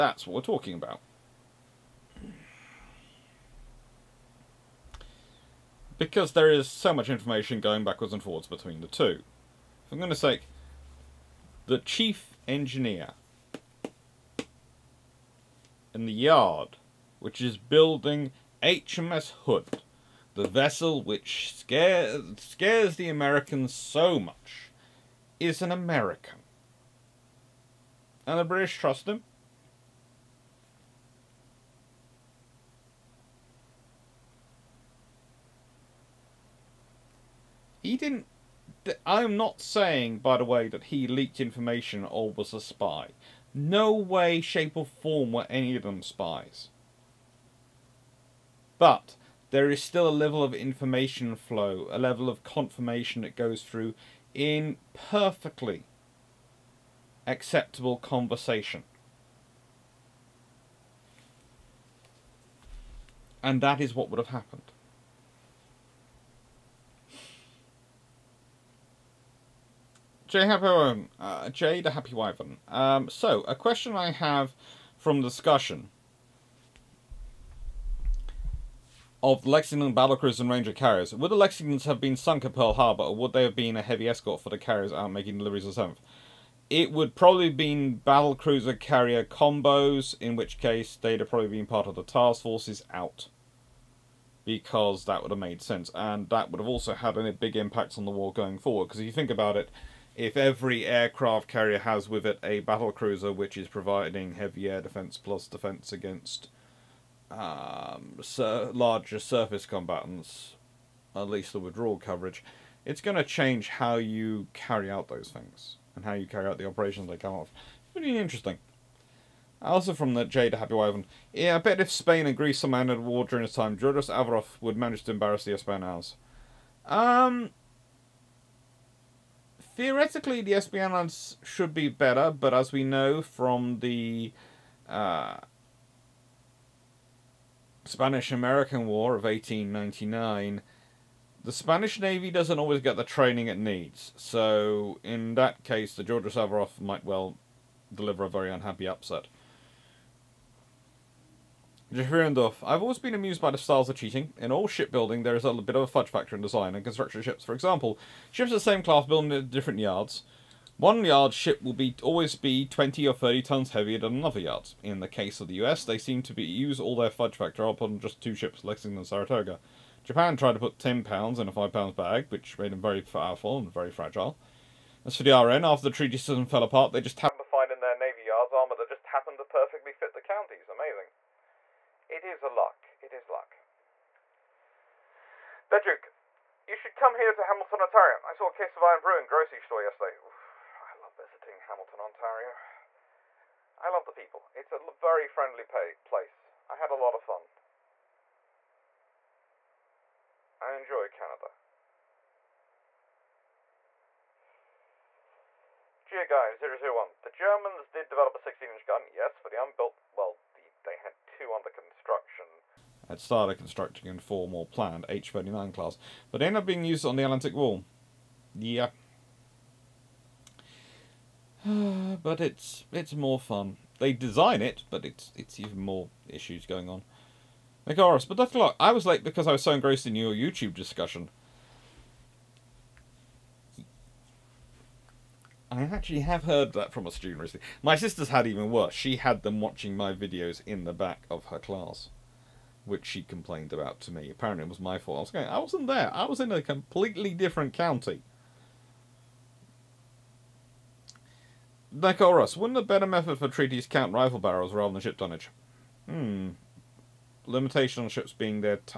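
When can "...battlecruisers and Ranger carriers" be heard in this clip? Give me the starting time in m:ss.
1:19.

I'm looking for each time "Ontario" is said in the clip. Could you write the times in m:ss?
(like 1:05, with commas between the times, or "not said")
3:07, 3:11.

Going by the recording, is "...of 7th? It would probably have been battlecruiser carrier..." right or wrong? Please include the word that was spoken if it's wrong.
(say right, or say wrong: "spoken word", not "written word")
right.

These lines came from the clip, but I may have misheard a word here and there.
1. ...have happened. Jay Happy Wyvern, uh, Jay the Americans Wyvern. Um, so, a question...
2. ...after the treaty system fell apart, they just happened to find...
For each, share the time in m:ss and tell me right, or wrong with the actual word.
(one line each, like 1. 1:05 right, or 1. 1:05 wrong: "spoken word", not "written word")
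1. 1:04 wrong: "Happy", not "Americans"
2. 2:55 right.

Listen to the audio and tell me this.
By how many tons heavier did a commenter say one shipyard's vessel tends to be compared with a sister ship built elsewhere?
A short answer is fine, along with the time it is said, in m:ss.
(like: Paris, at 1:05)
20 or 30, at 2:42.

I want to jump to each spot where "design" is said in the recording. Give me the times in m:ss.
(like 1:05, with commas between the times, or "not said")
2:36, 3:44.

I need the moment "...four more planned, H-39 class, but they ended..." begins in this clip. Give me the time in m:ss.
3:34.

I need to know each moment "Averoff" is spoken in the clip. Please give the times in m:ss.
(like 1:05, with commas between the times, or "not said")
2:04, 2:26.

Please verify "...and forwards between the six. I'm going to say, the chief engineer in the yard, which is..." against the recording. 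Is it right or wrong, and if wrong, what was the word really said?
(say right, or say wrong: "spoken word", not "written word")
wrong: "two", not "six".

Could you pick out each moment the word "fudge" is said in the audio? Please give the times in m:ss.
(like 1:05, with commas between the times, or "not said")
2:35, 2:47.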